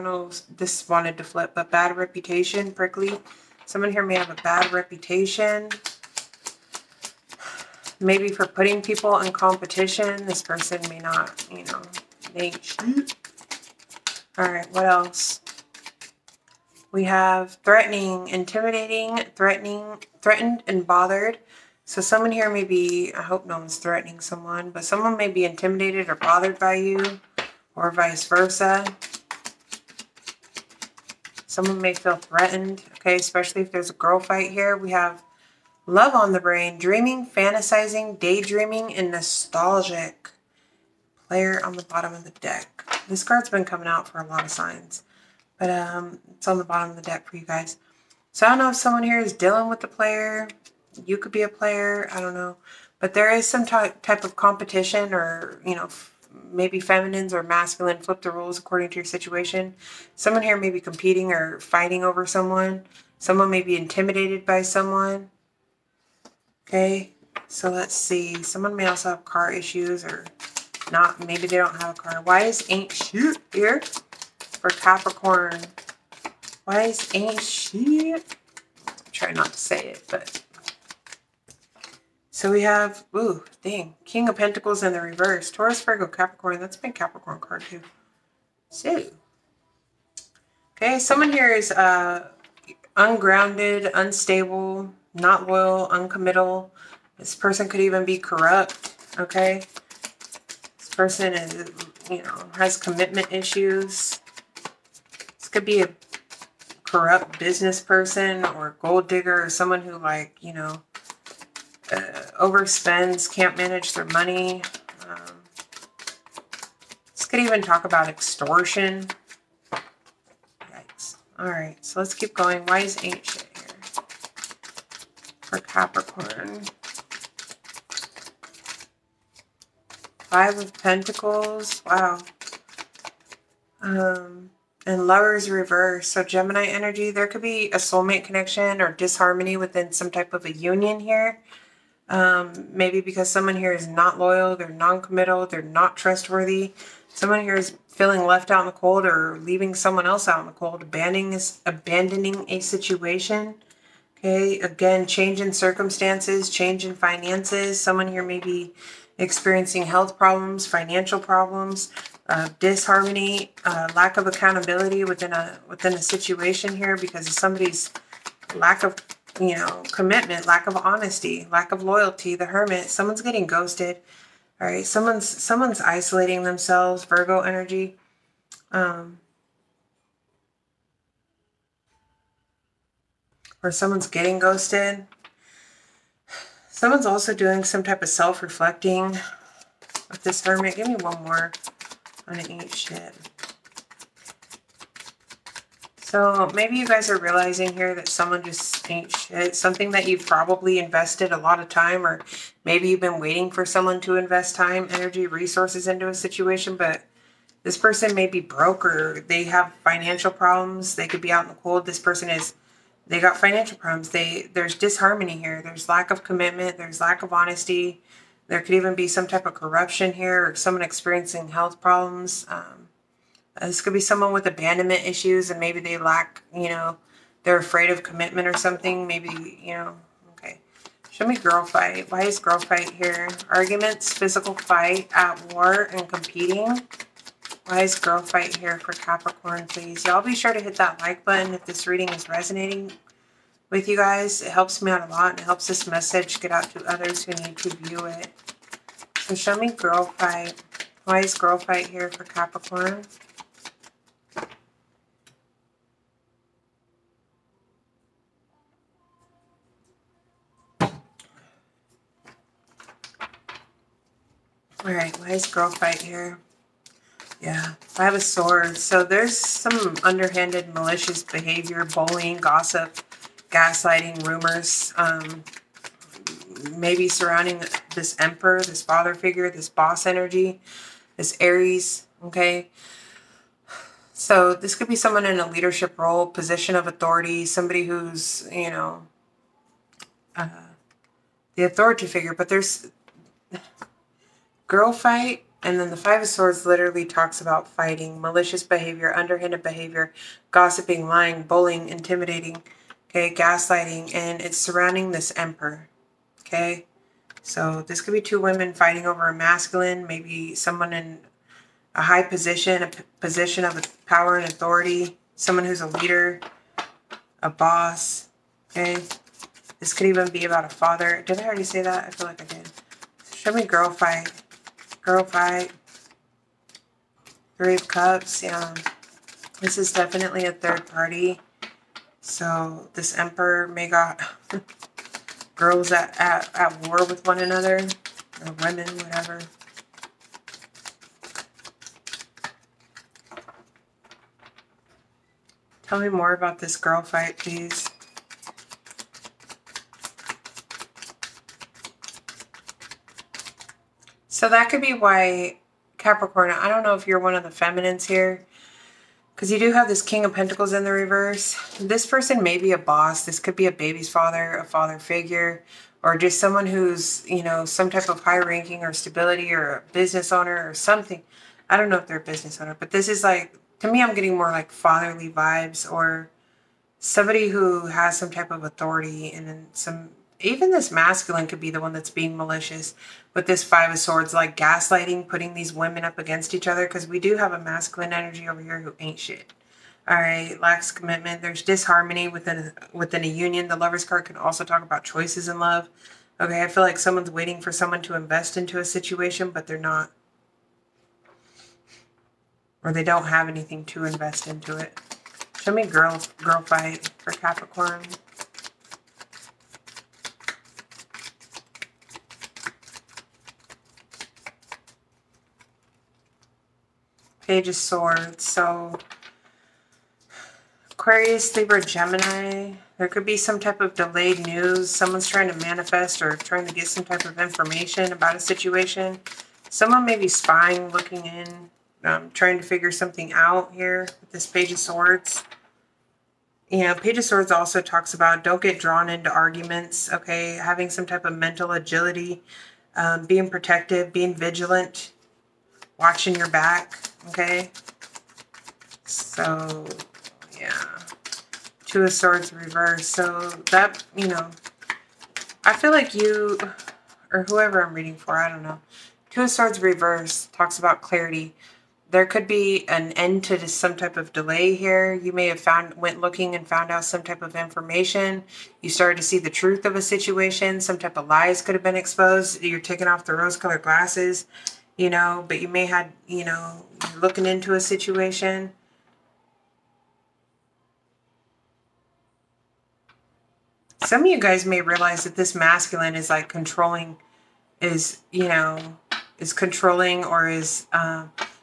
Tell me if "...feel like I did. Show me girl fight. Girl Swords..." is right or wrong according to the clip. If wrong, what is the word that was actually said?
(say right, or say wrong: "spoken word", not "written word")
wrong: "Fight", not "Swords".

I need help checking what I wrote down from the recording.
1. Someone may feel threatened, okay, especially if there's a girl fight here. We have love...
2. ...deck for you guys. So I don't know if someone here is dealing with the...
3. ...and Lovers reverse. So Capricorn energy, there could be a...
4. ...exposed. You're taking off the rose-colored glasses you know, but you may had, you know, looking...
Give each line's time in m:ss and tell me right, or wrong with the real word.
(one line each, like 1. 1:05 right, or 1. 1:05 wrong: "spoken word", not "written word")
1. 0:31 right
2. 0:47 right
3. 2:14 wrong: "Gemini", not "Capricorn"
4. 7:51 right.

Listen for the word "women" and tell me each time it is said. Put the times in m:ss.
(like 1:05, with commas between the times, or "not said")
5:08, 5:38, 6:25.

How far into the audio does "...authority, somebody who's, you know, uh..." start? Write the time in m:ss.
4:46.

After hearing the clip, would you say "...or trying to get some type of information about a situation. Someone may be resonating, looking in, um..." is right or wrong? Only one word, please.
wrong.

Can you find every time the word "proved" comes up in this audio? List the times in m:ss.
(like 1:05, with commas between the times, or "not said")
not said.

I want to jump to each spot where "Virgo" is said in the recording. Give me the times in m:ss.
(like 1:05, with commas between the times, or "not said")
1:25, 2:57.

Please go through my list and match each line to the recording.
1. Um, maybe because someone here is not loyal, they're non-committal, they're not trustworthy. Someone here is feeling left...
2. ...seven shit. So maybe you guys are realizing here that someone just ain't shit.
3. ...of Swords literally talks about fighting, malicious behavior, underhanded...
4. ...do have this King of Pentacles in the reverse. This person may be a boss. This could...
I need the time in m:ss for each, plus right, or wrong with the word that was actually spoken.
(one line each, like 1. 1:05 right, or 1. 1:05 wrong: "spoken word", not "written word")
1. 2:22 right
2. 3:12 wrong: "eight", not "seven"
3. 4:56 right
4. 5:59 right.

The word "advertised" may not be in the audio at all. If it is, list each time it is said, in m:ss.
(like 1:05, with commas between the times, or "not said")
not said.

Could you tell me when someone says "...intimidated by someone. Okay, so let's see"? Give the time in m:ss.
1:03.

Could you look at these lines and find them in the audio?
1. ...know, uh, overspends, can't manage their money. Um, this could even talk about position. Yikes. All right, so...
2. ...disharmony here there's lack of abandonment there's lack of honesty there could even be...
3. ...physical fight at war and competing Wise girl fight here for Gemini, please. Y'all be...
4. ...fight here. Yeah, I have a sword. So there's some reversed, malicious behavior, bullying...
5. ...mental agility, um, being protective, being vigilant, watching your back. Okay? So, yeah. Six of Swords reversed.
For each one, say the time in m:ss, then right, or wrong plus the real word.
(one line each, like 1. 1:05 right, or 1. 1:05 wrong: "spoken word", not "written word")
1. 1:50 wrong: "extortion", not "position"
2. 3:34 wrong: "commitment", not "abandonment"
3. 3:54 wrong: "Capricorn", not "Gemini"
4. 4:25 wrong: "underhanded", not "reversed"
5. 7:21 wrong: "Two", not "Six".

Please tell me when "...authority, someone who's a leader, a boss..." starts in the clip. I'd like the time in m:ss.
5:14.